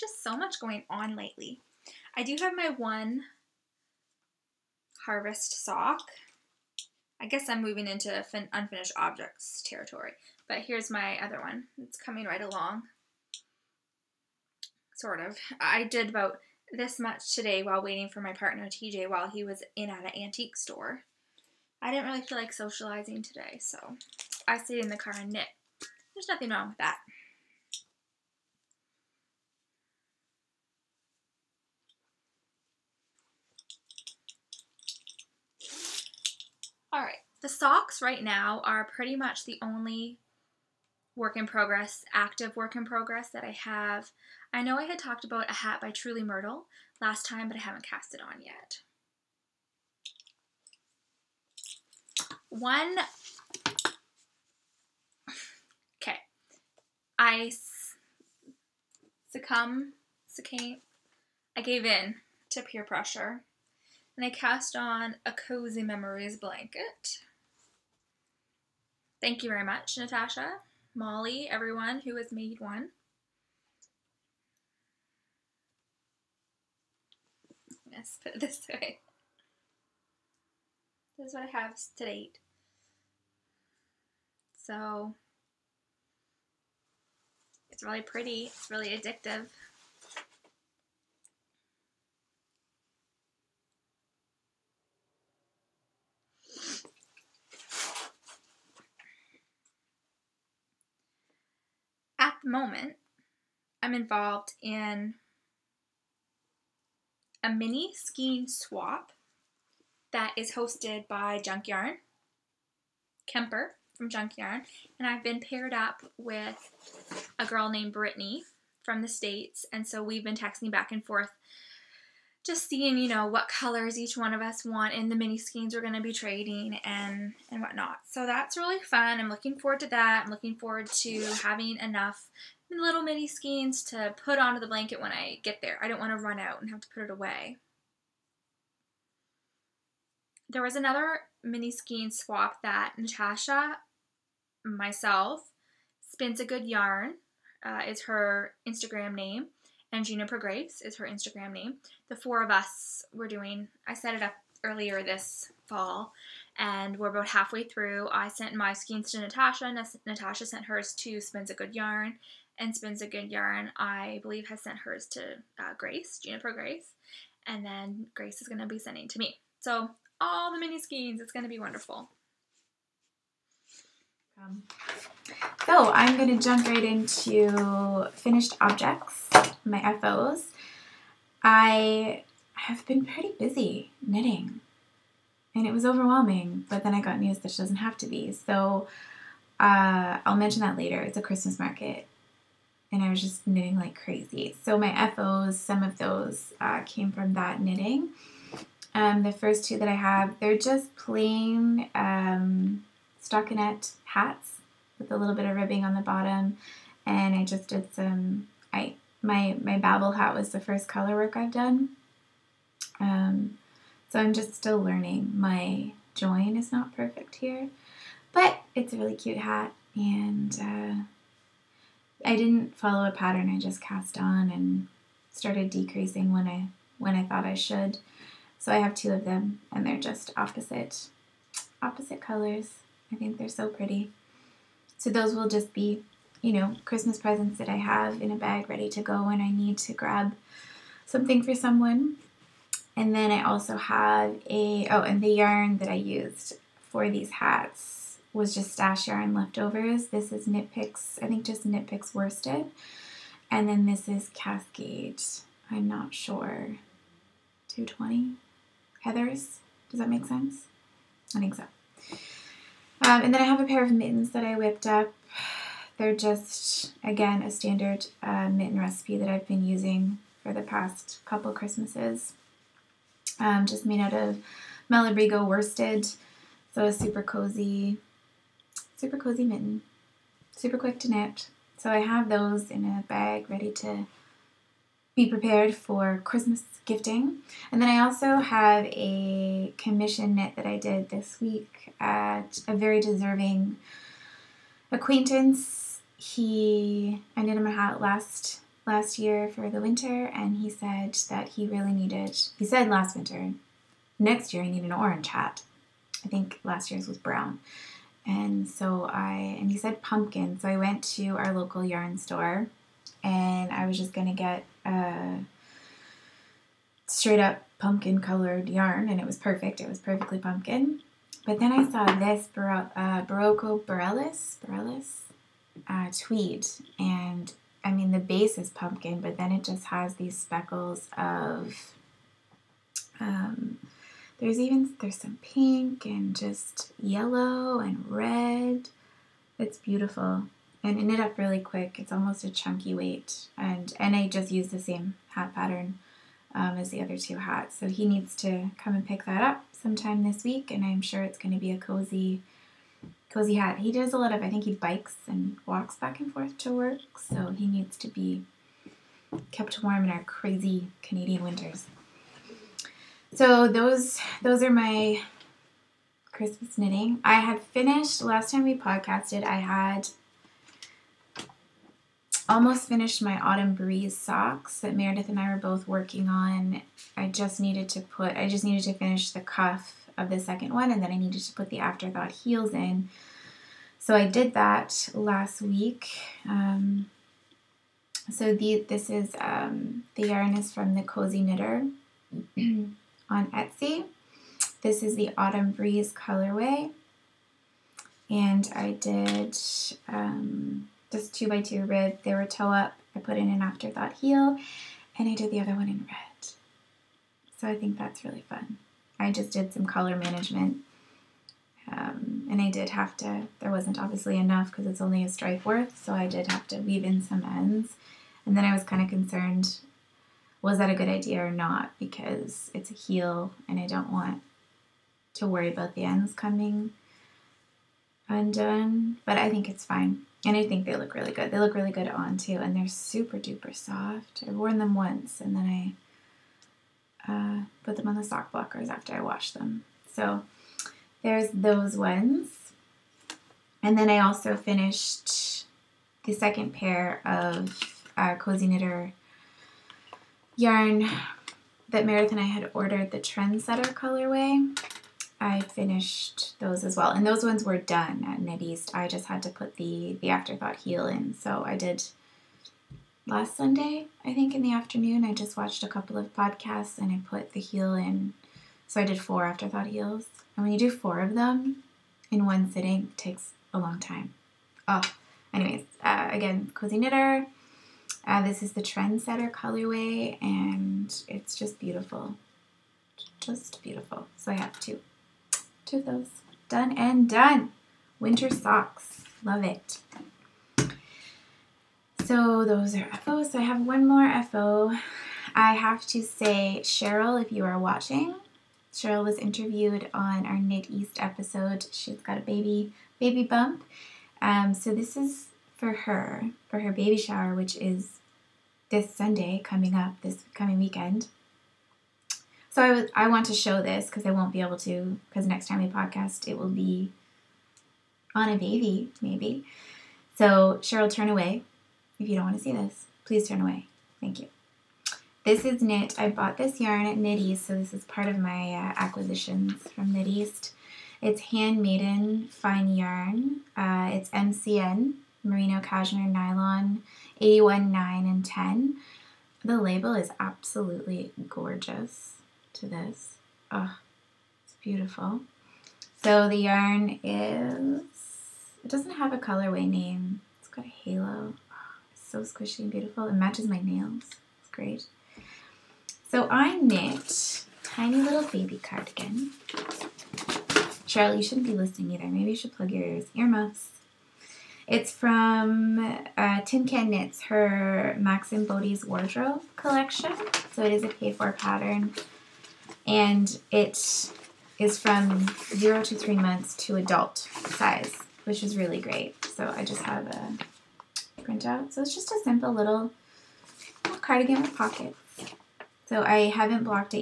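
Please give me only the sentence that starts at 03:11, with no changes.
It's a Christmas market and I was just knitting like crazy.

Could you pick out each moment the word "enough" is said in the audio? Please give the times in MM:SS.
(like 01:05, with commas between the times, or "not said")
02:11, 06:54.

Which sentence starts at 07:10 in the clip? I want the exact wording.
And I think they look really good.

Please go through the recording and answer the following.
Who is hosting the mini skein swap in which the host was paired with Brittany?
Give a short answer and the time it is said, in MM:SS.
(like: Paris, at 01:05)
Kemper from Junk Yarn, at 01:53.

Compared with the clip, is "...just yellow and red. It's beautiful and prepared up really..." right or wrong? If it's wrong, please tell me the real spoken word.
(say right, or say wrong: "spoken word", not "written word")
wrong: "ended", not "prepared".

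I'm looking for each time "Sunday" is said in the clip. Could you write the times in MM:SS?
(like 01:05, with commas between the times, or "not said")
07:43, 08:29.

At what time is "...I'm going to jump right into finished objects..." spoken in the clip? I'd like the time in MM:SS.
02:55.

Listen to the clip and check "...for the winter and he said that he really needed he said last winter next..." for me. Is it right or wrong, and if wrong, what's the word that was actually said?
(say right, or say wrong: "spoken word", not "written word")
right.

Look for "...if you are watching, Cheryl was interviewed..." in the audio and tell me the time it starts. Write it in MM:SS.
08:17.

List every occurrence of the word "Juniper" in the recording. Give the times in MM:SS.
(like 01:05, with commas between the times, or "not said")
02:30, 02:46.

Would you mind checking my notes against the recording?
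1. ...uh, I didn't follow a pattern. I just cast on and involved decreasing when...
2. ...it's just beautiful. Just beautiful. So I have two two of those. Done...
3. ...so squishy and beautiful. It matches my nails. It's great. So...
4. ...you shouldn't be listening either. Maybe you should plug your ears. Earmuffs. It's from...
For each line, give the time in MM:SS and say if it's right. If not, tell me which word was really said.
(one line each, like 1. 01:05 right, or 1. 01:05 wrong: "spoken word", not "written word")
1. 03:40 wrong: "started", not "involved"
2. 08:01 right
3. 09:12 right
4. 09:21 right.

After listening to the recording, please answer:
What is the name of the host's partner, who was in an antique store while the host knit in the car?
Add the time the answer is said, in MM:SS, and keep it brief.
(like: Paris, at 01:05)
TJ, at 00:18.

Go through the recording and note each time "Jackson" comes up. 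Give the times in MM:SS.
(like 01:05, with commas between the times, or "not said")
not said.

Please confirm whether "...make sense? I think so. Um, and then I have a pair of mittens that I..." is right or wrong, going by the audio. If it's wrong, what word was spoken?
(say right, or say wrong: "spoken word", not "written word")
right.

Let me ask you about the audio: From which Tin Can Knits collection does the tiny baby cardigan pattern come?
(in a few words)
Max and Bodie's wardrobe.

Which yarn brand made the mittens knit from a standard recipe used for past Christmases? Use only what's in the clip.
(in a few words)
Malabrigo.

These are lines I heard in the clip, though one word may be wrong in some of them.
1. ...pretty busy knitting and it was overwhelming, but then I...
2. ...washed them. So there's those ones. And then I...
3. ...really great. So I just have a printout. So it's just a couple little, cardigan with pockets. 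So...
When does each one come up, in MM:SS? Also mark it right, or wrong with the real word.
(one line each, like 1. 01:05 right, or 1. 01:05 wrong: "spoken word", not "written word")
1. 03:03 right
2. 07:19 right
3. 09:38 wrong: "simple", not "couple".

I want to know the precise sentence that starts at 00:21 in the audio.
I didn't really feel like socializing today, so I stayed in the car and knit.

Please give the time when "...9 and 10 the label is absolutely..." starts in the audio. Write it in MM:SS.
08:57.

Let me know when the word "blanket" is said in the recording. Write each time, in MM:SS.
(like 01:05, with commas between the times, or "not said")
01:06, 02:14.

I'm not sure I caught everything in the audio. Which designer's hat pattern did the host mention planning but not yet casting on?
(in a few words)
Truly Myrtle.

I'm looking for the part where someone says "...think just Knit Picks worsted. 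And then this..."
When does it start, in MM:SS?
04:11.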